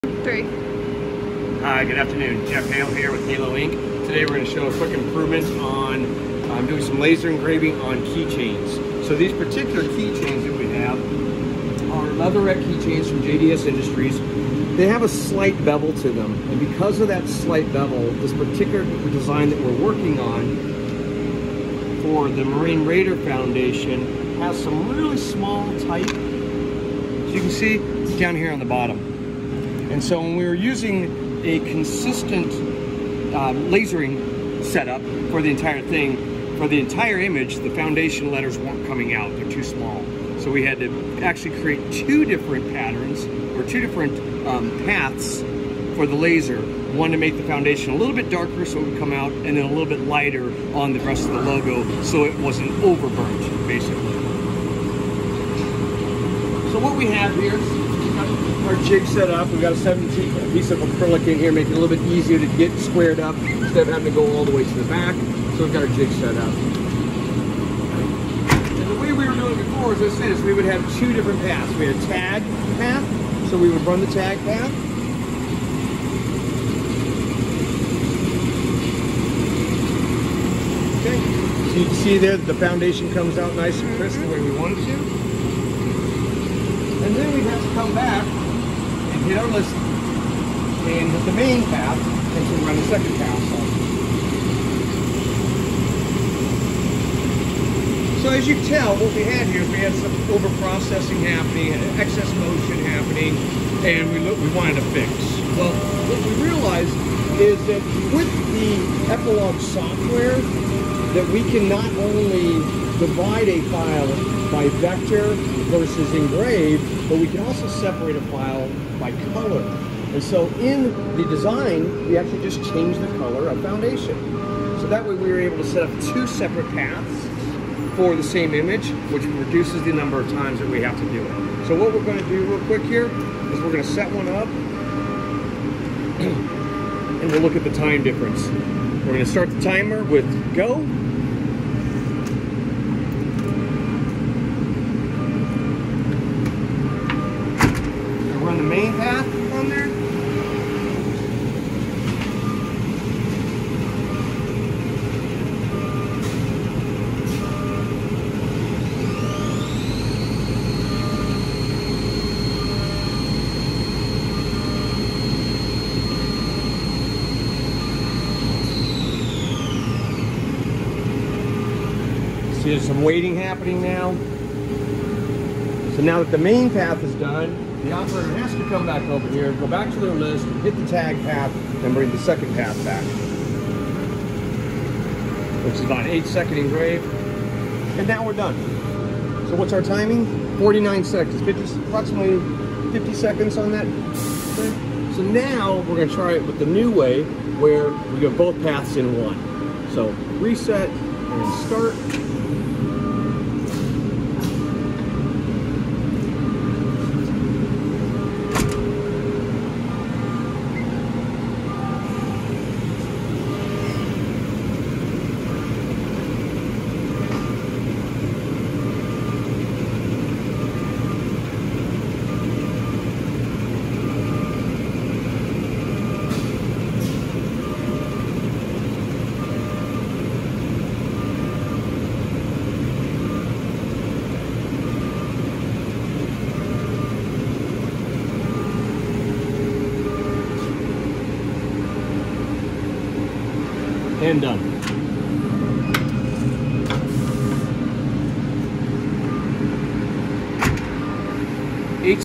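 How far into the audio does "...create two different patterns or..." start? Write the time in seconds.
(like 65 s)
41 s.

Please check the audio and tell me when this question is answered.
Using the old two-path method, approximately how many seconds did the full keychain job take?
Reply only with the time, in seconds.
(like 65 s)
191 s.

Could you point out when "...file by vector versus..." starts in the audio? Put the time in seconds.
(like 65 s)
113 s.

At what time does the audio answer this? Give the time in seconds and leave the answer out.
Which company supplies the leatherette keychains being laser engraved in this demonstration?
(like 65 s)
13 s.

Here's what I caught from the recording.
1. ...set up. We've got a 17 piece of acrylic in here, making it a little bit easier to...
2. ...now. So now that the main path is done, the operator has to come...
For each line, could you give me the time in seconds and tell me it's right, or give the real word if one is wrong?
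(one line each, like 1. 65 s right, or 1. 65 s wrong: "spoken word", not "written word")
1. 59 s right
2. 173 s right.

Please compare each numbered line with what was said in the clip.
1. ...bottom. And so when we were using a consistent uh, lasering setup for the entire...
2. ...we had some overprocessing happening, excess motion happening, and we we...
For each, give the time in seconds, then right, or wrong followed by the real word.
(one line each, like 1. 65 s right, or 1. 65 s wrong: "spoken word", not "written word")
1. 28 s right
2. 99 s right.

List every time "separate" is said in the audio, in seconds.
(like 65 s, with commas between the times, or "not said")
117 s, 126 s.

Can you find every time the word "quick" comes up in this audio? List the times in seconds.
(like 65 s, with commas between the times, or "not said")
4 s, 132 s.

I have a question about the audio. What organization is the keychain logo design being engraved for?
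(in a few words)
Marine Raider Foundation.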